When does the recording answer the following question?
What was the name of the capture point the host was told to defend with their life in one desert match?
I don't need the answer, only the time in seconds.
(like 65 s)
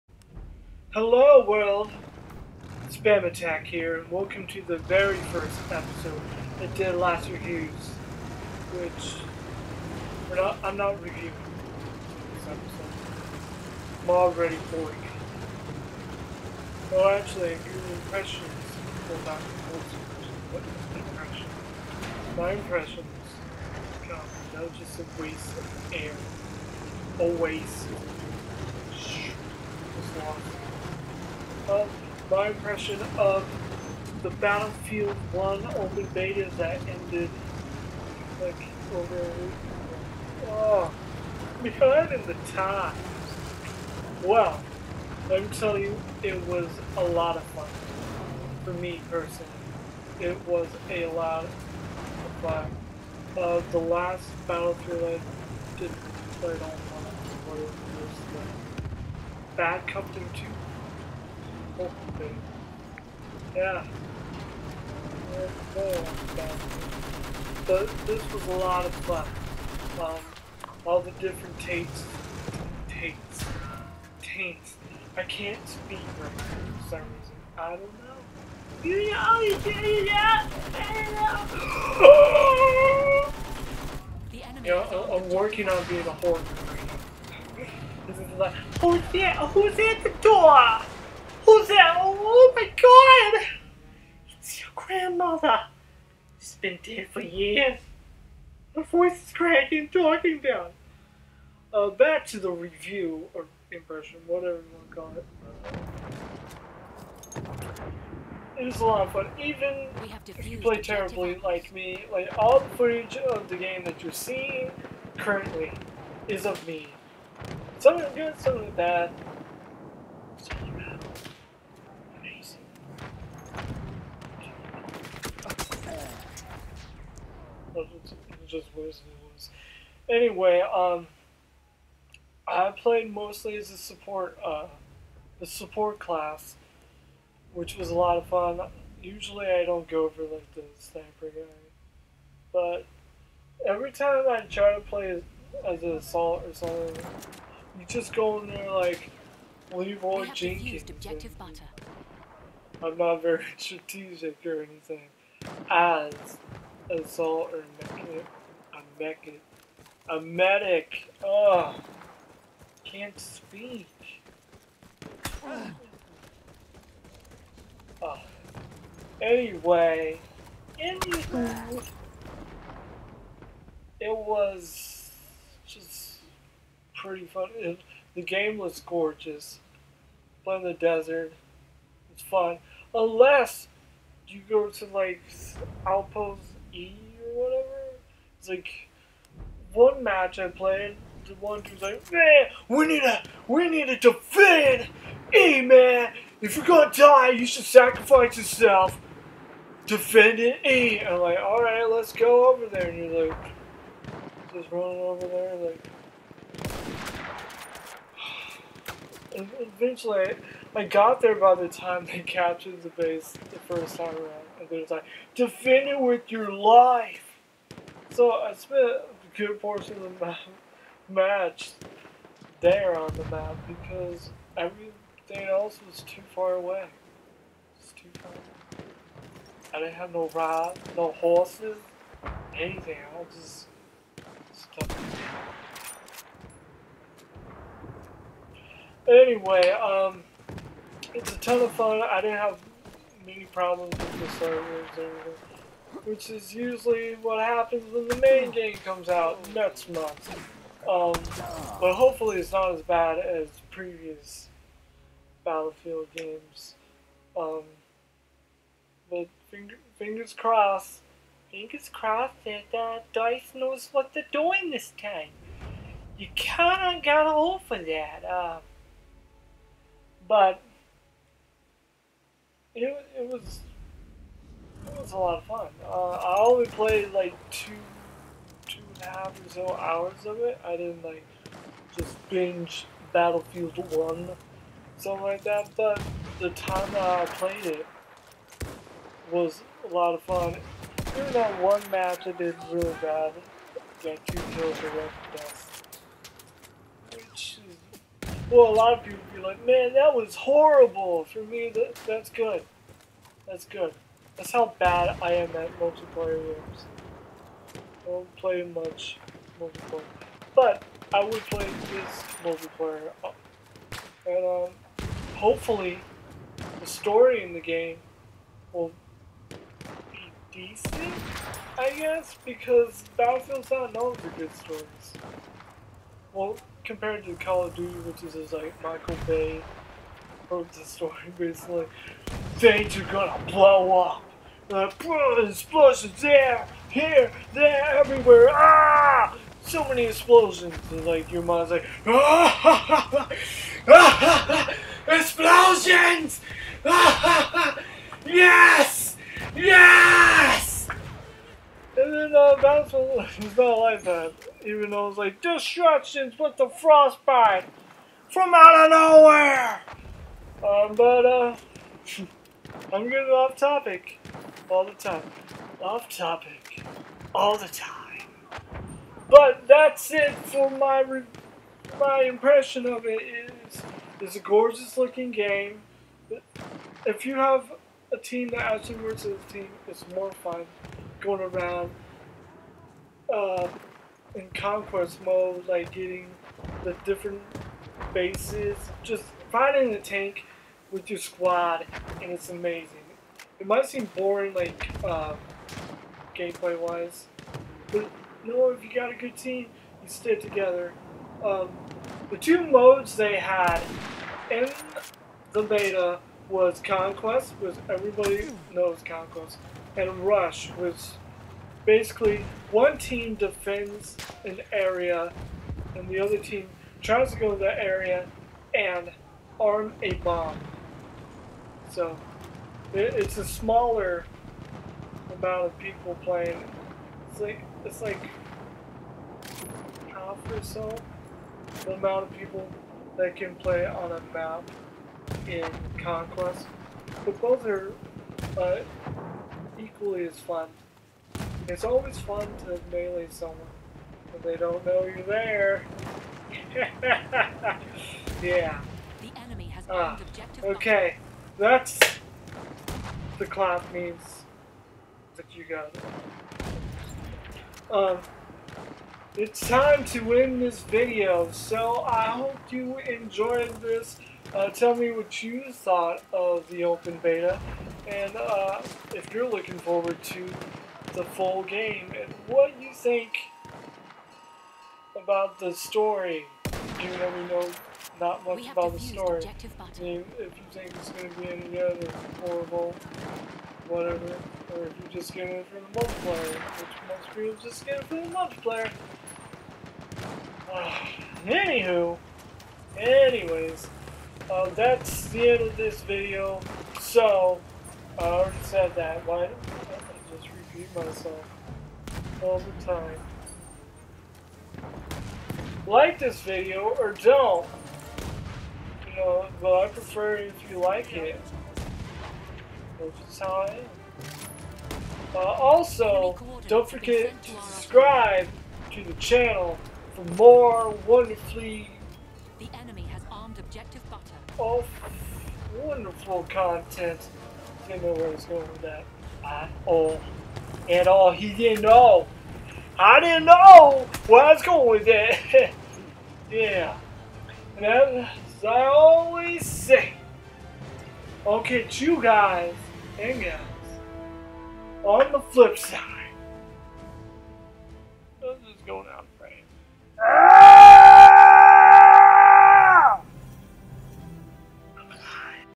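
185 s.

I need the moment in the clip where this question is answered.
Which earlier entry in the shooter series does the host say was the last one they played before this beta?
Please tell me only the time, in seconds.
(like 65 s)
59 s.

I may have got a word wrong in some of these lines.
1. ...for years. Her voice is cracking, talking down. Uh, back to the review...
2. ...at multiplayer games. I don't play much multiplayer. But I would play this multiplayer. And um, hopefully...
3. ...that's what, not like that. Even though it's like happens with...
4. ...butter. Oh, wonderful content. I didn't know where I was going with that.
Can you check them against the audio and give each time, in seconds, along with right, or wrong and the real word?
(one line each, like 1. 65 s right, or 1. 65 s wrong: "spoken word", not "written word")
1. 97 s right
2. 305 s right
3. 352 s wrong: "destructions", not "happens"
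4. 524 s right.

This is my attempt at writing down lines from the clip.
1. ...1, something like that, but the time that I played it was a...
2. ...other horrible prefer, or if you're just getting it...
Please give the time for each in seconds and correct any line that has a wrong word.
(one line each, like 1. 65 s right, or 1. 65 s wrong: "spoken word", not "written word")
1. 283 s right
2. 481 s wrong: "whatever", not "prefer".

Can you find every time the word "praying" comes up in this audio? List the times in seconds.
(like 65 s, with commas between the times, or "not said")
not said.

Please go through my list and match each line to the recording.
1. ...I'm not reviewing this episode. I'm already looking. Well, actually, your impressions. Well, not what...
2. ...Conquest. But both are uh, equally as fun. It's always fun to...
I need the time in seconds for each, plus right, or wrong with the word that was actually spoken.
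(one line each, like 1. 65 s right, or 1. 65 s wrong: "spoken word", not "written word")
1. 10 s wrong: "boring", not "looking"
2. 436 s right.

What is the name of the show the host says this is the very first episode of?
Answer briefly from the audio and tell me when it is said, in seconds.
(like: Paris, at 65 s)
Dead Last Reviews, at 6 s.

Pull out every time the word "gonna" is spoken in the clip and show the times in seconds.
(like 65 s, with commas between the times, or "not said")
196 s, 333 s.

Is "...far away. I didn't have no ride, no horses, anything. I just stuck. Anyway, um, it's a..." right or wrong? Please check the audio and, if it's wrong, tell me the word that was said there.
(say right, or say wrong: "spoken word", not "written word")
right.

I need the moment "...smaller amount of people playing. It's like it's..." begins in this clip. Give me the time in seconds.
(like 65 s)
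423 s.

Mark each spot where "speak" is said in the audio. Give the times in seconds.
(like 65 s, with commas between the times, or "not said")
75 s, 163 s.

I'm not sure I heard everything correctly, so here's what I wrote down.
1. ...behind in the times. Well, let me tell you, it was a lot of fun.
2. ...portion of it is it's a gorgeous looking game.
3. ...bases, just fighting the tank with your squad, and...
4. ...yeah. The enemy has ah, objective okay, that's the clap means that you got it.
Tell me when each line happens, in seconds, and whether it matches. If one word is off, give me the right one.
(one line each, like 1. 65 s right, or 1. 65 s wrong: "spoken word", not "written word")
1. 41 s right
2. 372 s wrong: "impression", not "portion"
3. 388 s right
4. 448 s right.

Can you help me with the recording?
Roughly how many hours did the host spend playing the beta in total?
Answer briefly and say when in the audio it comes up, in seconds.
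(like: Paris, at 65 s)
2 and a half hours, at 278 s.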